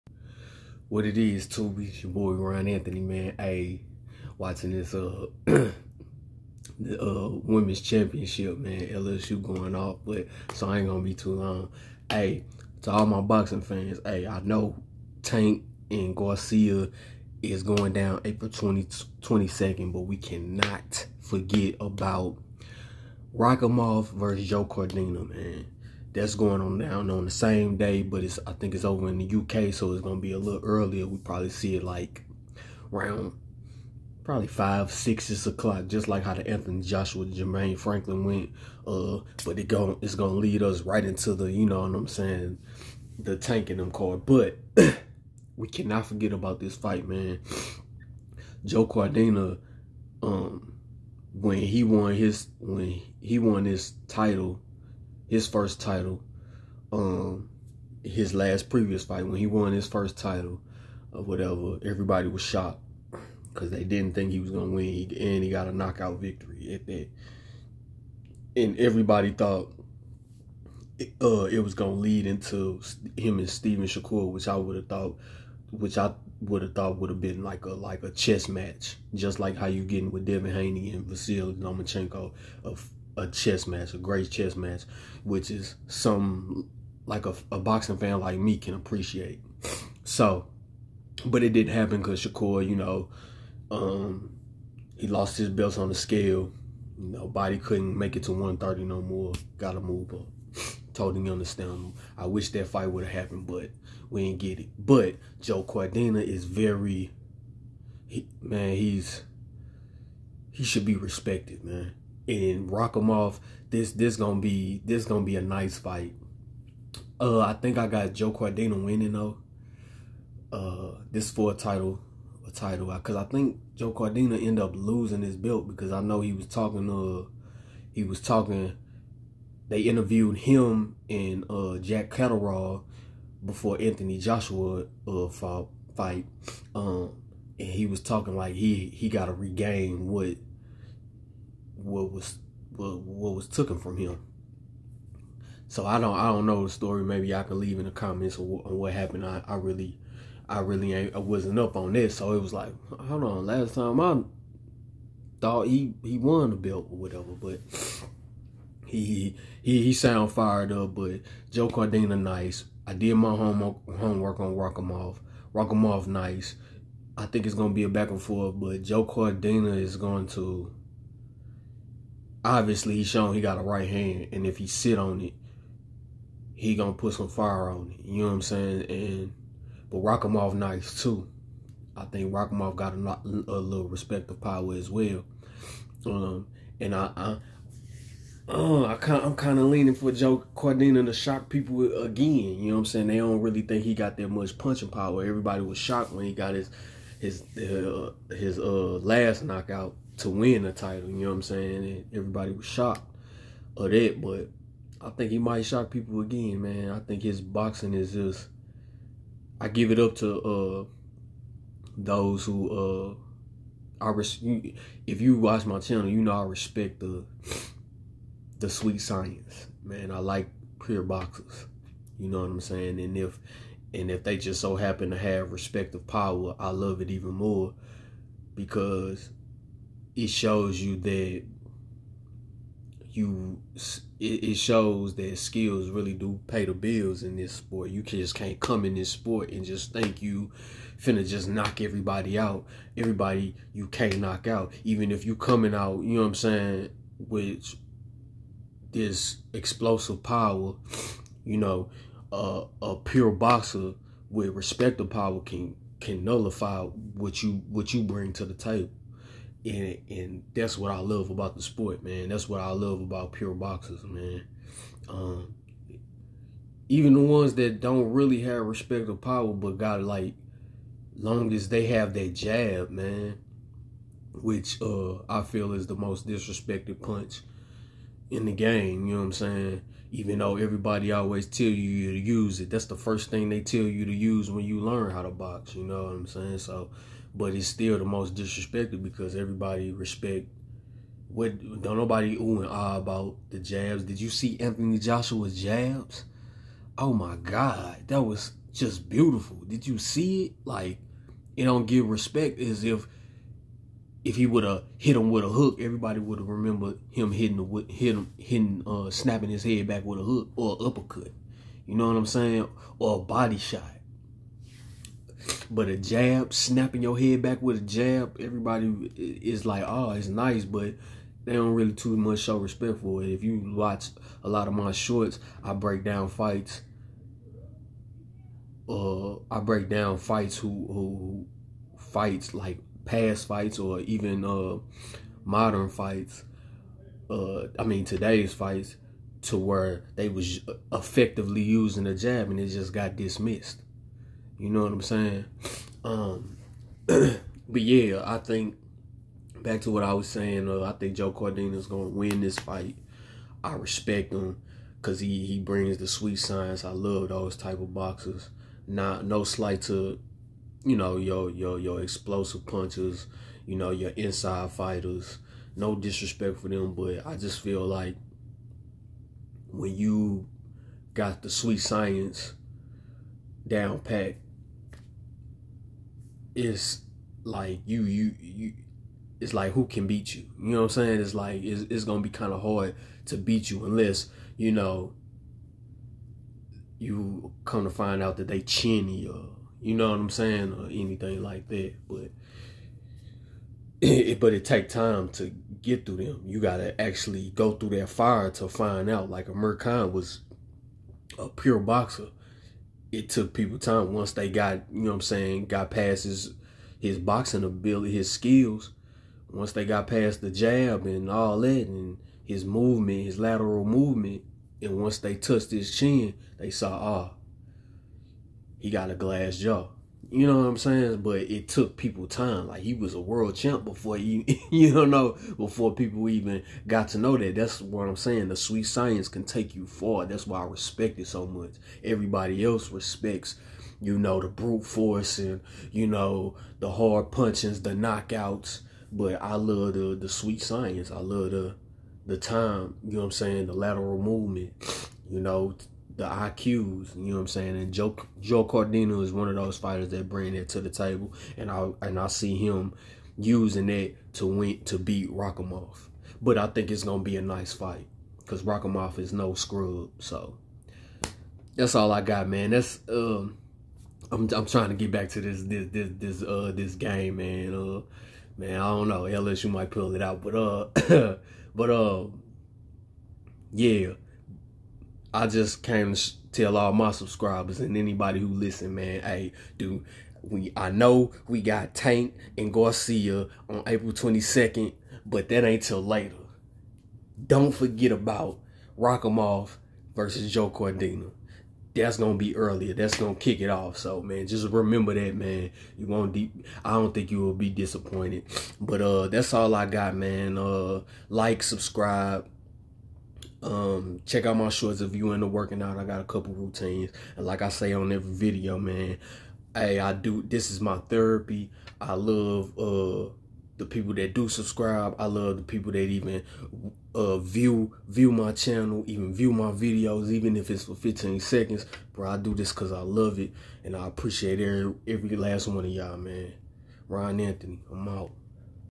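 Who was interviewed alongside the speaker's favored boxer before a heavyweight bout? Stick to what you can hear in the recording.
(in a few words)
Jack Catterall.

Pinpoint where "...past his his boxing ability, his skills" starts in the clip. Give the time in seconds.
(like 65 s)
405 s.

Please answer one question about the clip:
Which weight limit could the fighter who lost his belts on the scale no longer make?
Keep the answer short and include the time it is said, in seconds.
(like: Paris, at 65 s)
130, at 98 s.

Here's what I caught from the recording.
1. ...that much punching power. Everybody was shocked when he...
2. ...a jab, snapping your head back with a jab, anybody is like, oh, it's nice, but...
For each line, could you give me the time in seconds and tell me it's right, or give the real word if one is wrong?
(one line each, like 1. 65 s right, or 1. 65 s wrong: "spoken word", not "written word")
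1. 194 s right
2. 315 s wrong: "everybody", not "anybody".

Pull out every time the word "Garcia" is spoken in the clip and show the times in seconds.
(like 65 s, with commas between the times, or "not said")
16 s, 482 s.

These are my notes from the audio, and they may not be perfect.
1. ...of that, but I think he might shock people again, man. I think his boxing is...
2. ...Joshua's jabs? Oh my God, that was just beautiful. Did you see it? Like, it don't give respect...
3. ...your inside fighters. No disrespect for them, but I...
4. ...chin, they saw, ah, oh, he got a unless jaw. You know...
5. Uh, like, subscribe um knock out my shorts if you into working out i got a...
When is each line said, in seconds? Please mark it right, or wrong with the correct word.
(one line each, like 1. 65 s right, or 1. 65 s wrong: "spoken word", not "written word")
1. 203 s right
2. 294 s right
3. 363 s right
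4. 415 s wrong: "glass", not "unless"
5. 500 s wrong: "check", not "knock".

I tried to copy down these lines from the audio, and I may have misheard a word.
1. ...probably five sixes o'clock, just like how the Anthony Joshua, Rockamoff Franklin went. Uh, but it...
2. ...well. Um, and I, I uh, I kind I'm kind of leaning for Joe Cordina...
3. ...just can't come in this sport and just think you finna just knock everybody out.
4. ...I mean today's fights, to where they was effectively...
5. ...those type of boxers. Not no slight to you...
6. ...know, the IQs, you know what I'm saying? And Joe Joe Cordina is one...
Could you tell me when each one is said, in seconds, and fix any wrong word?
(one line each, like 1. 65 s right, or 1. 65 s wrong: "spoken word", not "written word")
1. 34 s wrong: "Jermaine", not "Rockamoff"
2. 184 s right
3. 238 s right
4. 337 s right
5. 357 s right
6. 445 s right.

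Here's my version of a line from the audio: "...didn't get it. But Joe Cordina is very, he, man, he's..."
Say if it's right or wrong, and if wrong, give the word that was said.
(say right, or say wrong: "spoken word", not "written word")
right.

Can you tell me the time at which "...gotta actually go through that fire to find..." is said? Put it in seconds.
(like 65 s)
396 s.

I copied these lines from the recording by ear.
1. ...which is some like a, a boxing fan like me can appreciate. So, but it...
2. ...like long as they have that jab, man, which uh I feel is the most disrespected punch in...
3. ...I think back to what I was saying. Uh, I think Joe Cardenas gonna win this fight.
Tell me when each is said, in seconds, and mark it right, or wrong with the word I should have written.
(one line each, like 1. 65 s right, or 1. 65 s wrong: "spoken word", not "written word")
1. 85 s right
2. 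270 s right
3. 348 s right.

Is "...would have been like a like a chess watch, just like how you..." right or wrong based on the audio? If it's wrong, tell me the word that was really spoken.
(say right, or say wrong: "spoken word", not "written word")
wrong: "match", not "watch".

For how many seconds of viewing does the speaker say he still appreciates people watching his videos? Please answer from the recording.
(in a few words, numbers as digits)
15.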